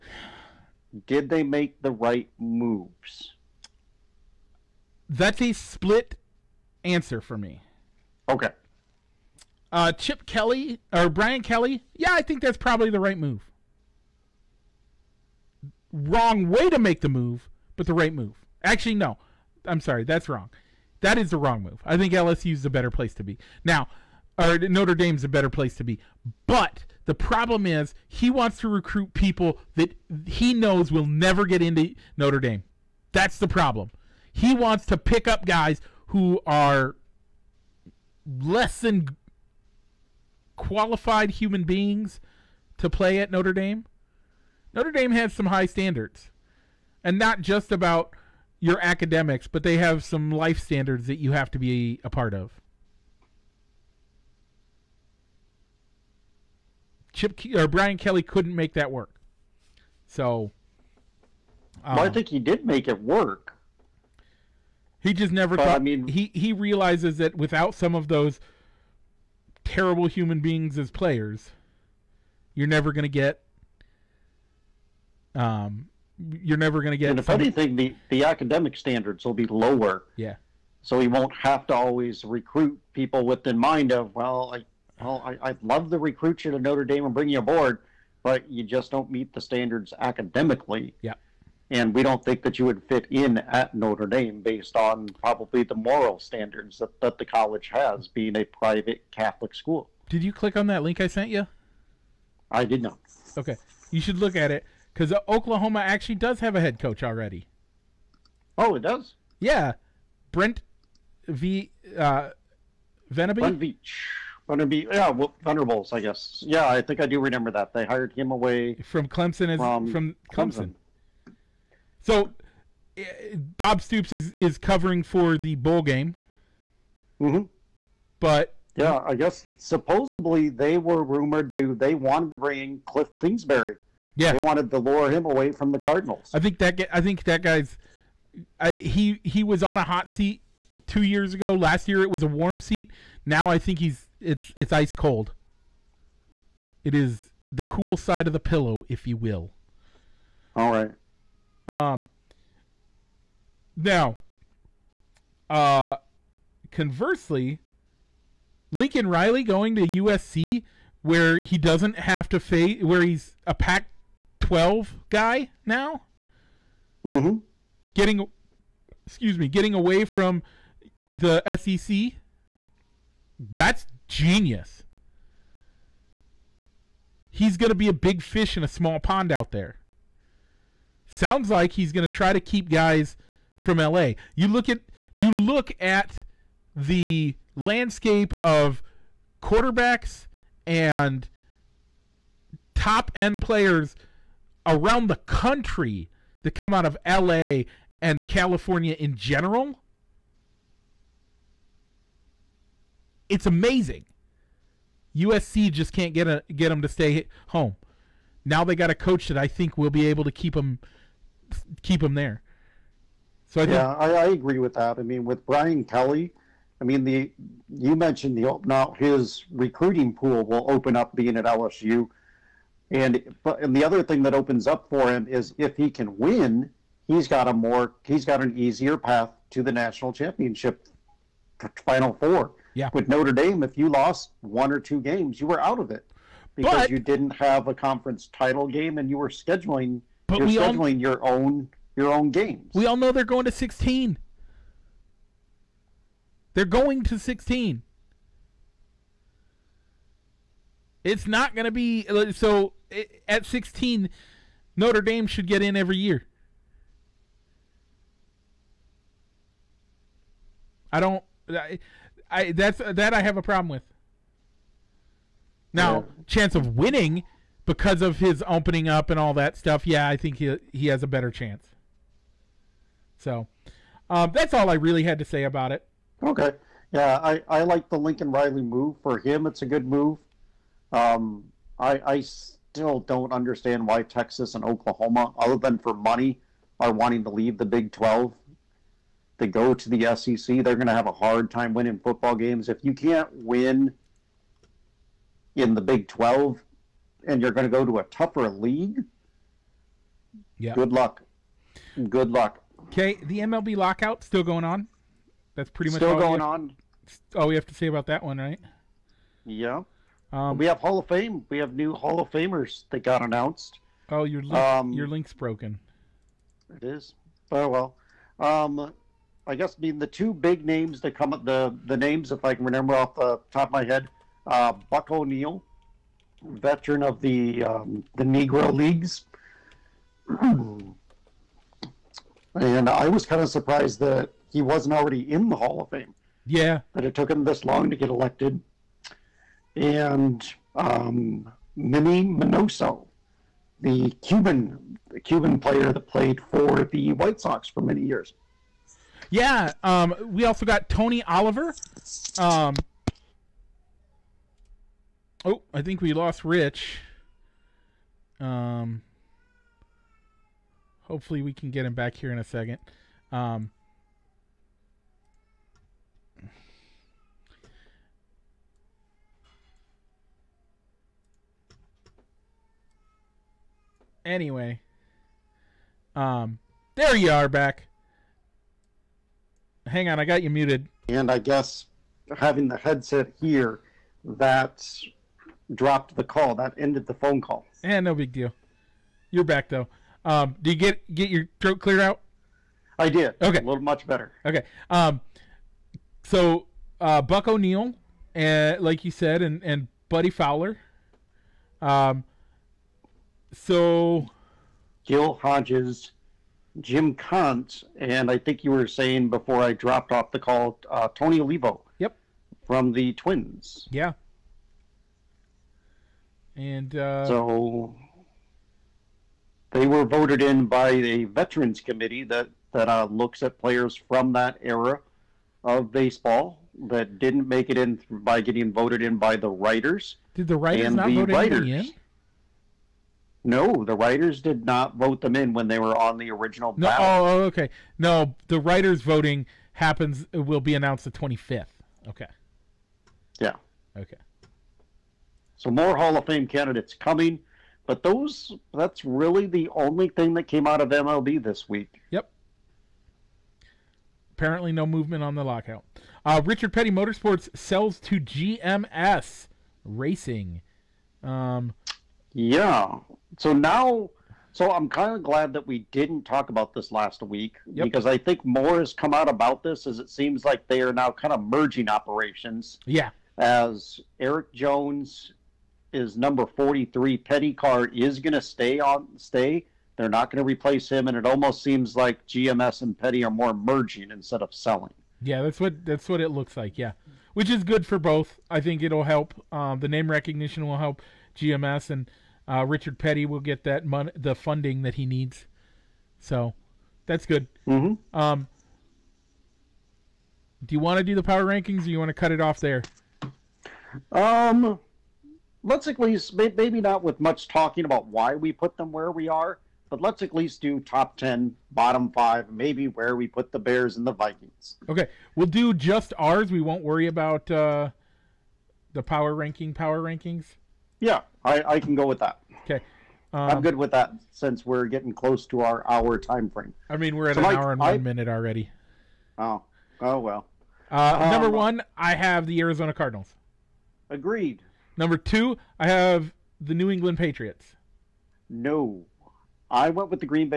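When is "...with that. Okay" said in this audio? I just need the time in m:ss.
8:42.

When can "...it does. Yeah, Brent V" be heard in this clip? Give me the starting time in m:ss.
1:48.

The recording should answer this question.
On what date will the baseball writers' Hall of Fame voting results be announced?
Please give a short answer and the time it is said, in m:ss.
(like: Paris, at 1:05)
the 25th, at 7:21.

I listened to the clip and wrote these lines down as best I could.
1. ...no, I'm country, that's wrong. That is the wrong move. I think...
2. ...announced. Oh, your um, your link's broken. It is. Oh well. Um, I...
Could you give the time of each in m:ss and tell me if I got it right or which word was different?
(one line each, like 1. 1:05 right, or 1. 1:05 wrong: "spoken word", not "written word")
1. 0:18 wrong: "sorry", not "country"
2. 5:13 right.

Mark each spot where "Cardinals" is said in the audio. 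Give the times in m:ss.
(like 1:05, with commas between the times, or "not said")
2:15, 8:52.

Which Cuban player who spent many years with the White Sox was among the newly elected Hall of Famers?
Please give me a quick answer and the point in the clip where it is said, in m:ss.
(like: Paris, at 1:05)
Minnie Minoso, at 5:41.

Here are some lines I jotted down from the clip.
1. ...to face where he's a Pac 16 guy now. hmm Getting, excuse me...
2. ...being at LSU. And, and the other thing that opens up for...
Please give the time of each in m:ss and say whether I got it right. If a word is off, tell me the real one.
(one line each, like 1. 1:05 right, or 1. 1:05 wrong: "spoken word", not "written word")
1. 2:42 wrong: "12", not "16"
2. 3:41 right.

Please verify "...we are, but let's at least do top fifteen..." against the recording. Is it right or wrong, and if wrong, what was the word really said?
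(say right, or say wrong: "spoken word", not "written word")
wrong: "ten", not "fifteen".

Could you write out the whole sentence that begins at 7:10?
Did the writers and not the vote writers, in?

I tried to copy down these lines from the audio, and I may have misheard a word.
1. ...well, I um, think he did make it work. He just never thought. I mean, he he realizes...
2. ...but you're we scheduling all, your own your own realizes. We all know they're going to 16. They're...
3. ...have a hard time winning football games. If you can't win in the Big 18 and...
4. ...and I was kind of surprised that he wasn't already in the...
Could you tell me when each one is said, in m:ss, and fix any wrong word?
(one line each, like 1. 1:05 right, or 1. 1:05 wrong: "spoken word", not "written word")
1. 1:01 right
2. 4:00 wrong: "games", not "realizes"
3. 4:50 wrong: "12", not "18"
4. 5:30 right.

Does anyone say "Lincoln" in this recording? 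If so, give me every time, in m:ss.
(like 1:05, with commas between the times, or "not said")
2:38, 4:37.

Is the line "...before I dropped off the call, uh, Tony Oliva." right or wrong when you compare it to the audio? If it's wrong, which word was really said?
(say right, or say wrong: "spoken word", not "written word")
right.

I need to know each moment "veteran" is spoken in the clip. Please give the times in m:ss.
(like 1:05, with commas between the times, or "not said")
5:26, 7:01.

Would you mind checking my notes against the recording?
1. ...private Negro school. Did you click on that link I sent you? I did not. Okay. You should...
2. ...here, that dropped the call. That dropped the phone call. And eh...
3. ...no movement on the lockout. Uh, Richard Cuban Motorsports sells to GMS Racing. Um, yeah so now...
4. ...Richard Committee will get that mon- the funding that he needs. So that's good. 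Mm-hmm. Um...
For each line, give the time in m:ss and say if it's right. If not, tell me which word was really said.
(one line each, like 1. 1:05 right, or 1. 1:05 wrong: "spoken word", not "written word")
1. 1:38 wrong: "Catholic", not "Negro"
2. 6:23 wrong: "ended", not "dropped"
3. 7:34 wrong: "Petty", not "Cuban"
4. 8:12 wrong: "Petty", not "Committee".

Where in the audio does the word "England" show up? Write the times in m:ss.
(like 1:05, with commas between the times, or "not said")
8:56.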